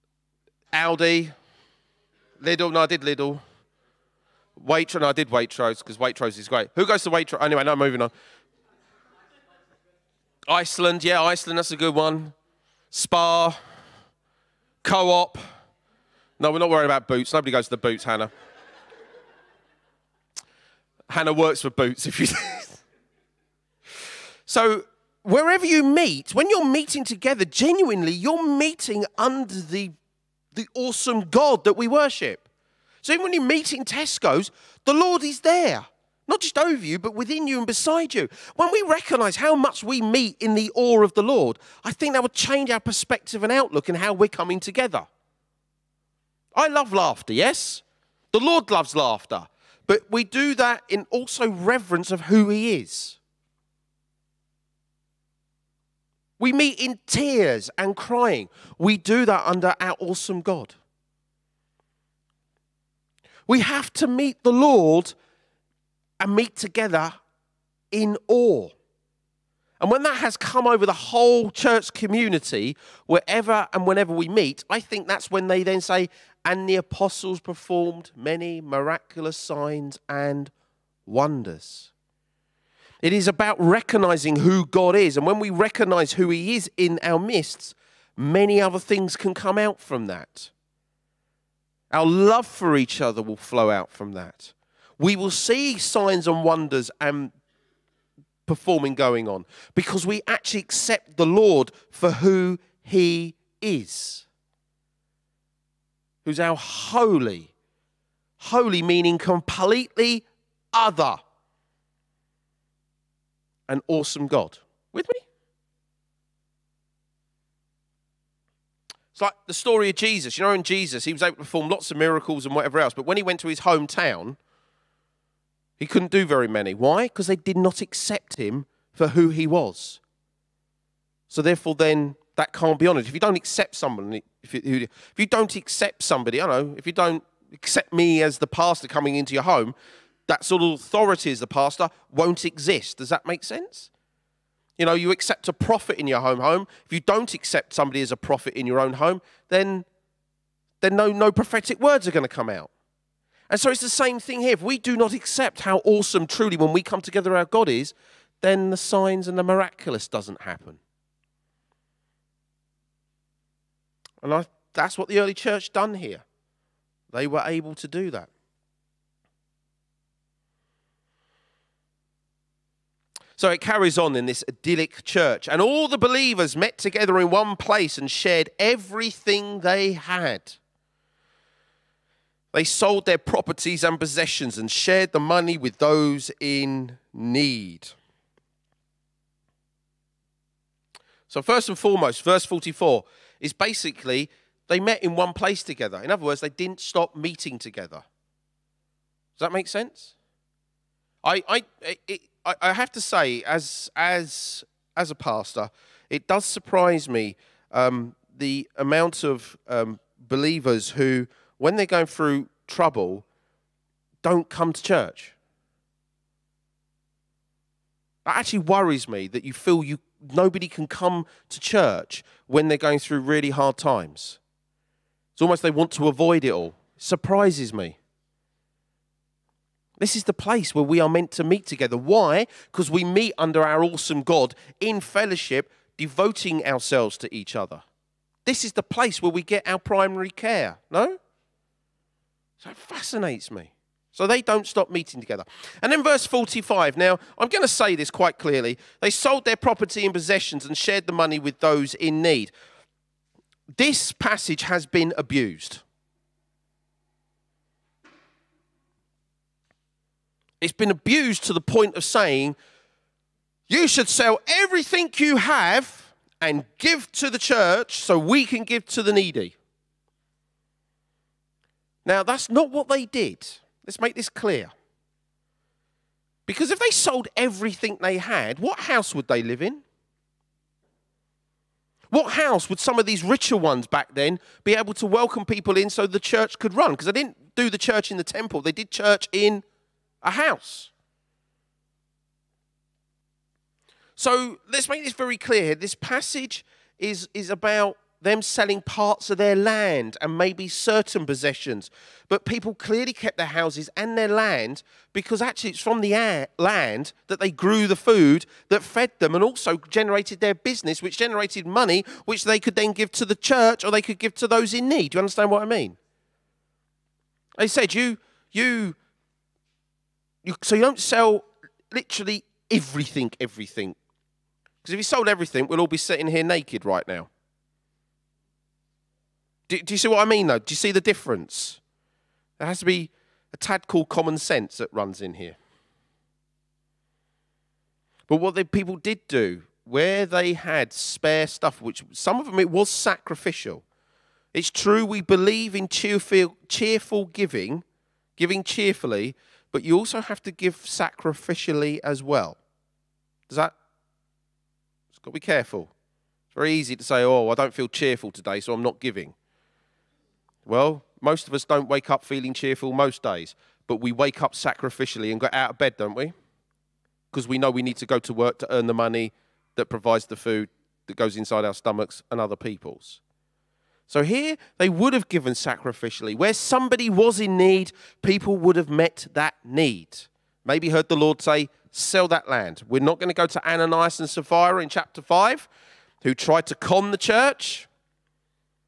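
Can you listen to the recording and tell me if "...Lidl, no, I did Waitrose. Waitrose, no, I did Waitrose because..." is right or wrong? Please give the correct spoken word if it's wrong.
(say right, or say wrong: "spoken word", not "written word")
wrong: "Lidl", not "Waitrose".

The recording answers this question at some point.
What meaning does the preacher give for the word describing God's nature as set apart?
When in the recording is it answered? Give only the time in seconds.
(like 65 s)
109 s.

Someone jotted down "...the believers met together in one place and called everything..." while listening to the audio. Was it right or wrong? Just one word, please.
wrong.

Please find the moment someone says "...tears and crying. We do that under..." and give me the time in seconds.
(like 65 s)
57 s.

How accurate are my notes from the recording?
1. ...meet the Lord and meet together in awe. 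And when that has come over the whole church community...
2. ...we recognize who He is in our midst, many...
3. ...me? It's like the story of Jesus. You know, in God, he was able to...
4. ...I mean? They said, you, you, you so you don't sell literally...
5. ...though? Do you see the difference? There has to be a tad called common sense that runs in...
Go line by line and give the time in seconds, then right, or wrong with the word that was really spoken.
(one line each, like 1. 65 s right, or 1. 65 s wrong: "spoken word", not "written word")
1. 64 s right
2. 85 s right
3. 115 s wrong: "Jesus", not "God"
4. 315 s right
5. 330 s right.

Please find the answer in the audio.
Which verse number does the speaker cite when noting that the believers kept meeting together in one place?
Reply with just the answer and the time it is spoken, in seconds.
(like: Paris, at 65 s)
44, at 192 s.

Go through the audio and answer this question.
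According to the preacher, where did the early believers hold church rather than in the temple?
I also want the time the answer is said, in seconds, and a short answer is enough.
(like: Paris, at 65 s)
in a house, at 289 s.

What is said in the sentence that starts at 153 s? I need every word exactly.
And so it's the same thing here.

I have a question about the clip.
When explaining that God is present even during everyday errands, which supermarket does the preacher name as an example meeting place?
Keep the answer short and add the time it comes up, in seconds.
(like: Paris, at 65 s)
Tesco's, at 33 s.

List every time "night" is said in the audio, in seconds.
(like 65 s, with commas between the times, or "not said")
not said.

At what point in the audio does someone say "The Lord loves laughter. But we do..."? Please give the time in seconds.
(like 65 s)
48 s.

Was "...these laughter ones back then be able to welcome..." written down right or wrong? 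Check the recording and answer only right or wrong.
wrong.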